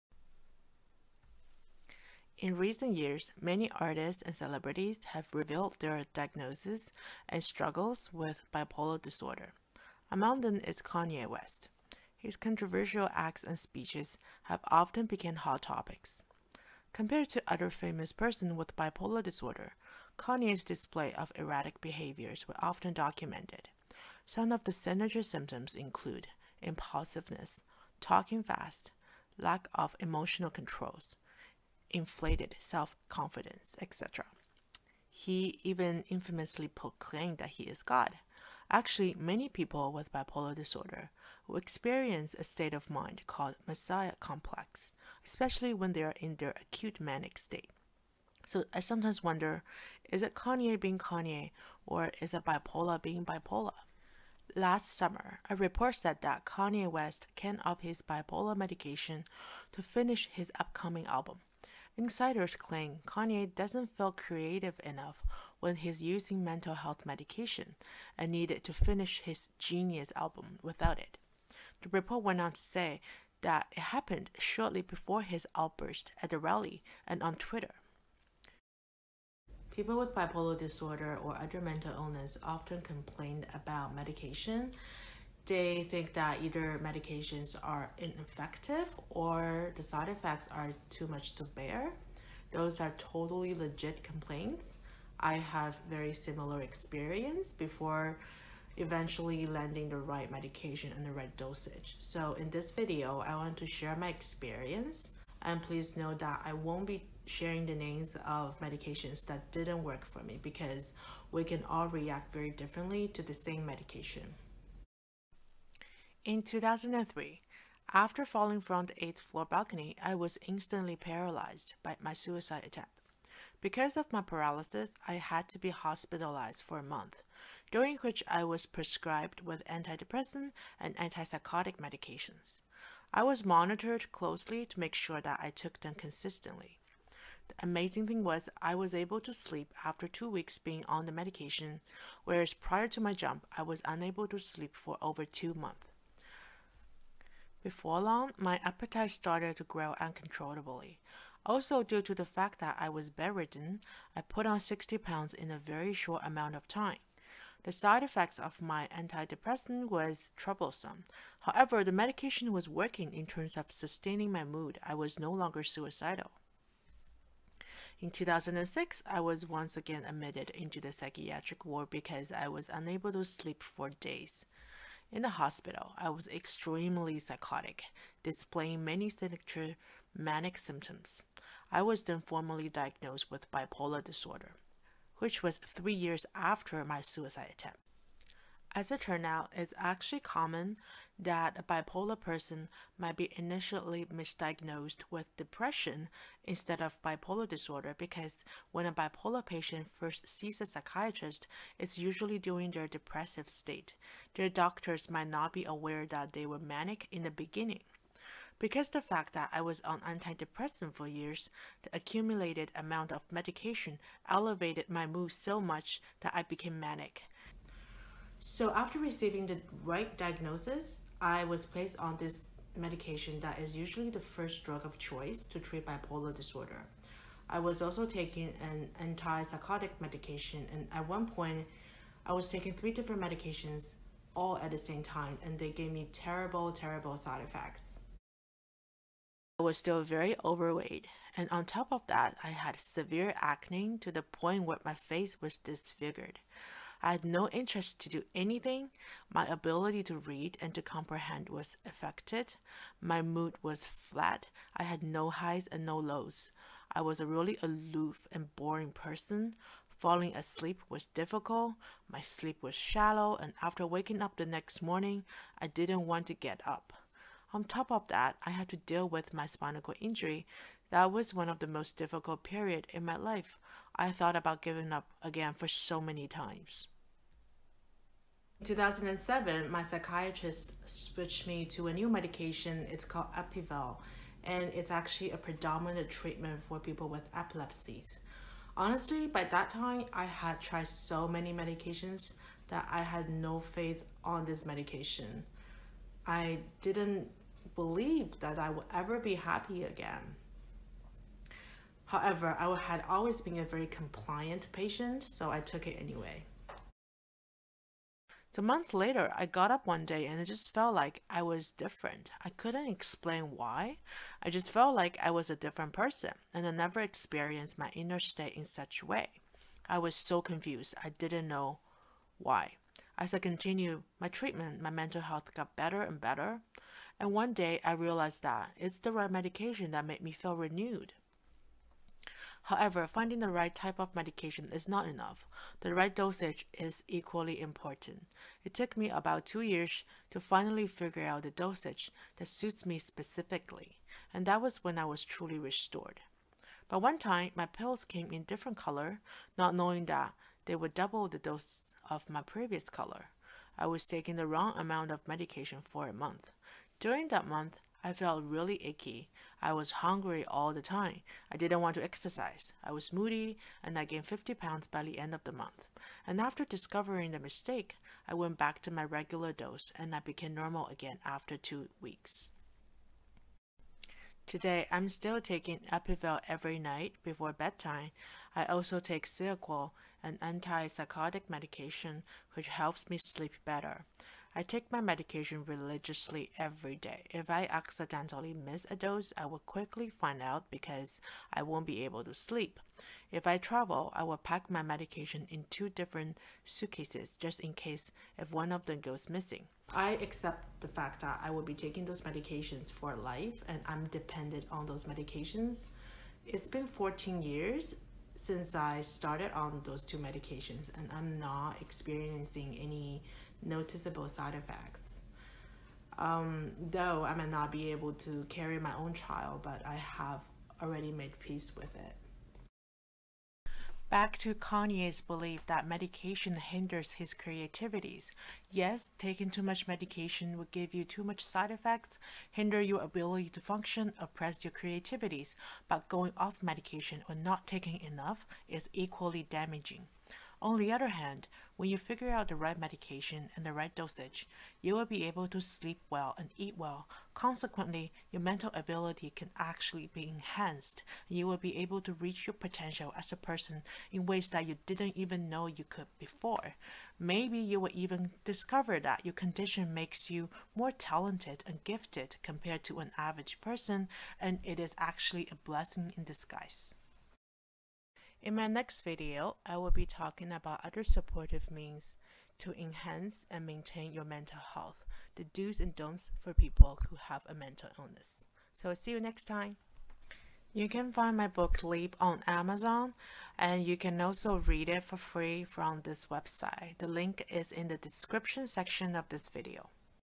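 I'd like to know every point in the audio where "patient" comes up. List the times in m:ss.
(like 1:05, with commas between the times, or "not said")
3:19, 5:04.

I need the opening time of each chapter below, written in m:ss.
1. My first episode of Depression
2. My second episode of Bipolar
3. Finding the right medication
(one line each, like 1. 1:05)
1. 1:19
2. 2:48
3. 4:38.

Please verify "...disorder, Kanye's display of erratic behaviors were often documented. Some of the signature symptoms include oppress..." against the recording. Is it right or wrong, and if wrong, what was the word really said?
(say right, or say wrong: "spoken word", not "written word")
wrong: "impulsiveness", not "oppress".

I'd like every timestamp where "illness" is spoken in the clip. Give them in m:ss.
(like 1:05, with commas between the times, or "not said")
1:21, 7:57.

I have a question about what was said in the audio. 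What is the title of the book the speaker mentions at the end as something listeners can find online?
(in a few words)
Leap.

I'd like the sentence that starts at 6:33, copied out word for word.
If I travel, I will pack my medication in two different suitcases just in case if one of them goes missing.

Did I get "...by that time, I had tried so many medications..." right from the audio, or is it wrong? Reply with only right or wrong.
right.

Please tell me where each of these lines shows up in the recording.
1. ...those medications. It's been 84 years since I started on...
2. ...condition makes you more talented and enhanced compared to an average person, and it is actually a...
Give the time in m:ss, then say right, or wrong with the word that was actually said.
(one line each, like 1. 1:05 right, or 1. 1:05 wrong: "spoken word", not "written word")
1. 6:44 wrong: "14", not "84"
2. 7:39 wrong: "gifted", not "enhanced".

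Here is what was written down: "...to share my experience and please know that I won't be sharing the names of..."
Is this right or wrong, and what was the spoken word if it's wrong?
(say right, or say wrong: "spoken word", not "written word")
right.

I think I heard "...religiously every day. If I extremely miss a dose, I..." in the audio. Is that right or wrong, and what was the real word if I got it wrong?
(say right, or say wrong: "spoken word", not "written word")
wrong: "accidentally", not "extremely".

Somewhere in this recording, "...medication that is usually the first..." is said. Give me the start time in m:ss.
3:42.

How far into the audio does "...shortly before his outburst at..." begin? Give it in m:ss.
1:14.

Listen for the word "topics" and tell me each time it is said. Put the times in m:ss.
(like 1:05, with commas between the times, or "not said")
0:15.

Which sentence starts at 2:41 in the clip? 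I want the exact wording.
However, the medication was working in terms of sustaining my mood.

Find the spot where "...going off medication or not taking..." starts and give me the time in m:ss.
7:16.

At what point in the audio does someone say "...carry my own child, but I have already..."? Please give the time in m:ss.
6:58.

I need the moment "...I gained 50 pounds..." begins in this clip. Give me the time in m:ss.
6:03.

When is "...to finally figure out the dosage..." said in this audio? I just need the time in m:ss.
5:40.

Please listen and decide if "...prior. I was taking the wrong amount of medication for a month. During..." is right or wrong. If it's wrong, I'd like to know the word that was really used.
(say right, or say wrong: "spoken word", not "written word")
wrong: "color", not "prior".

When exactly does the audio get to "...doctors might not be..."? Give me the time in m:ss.
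3:24.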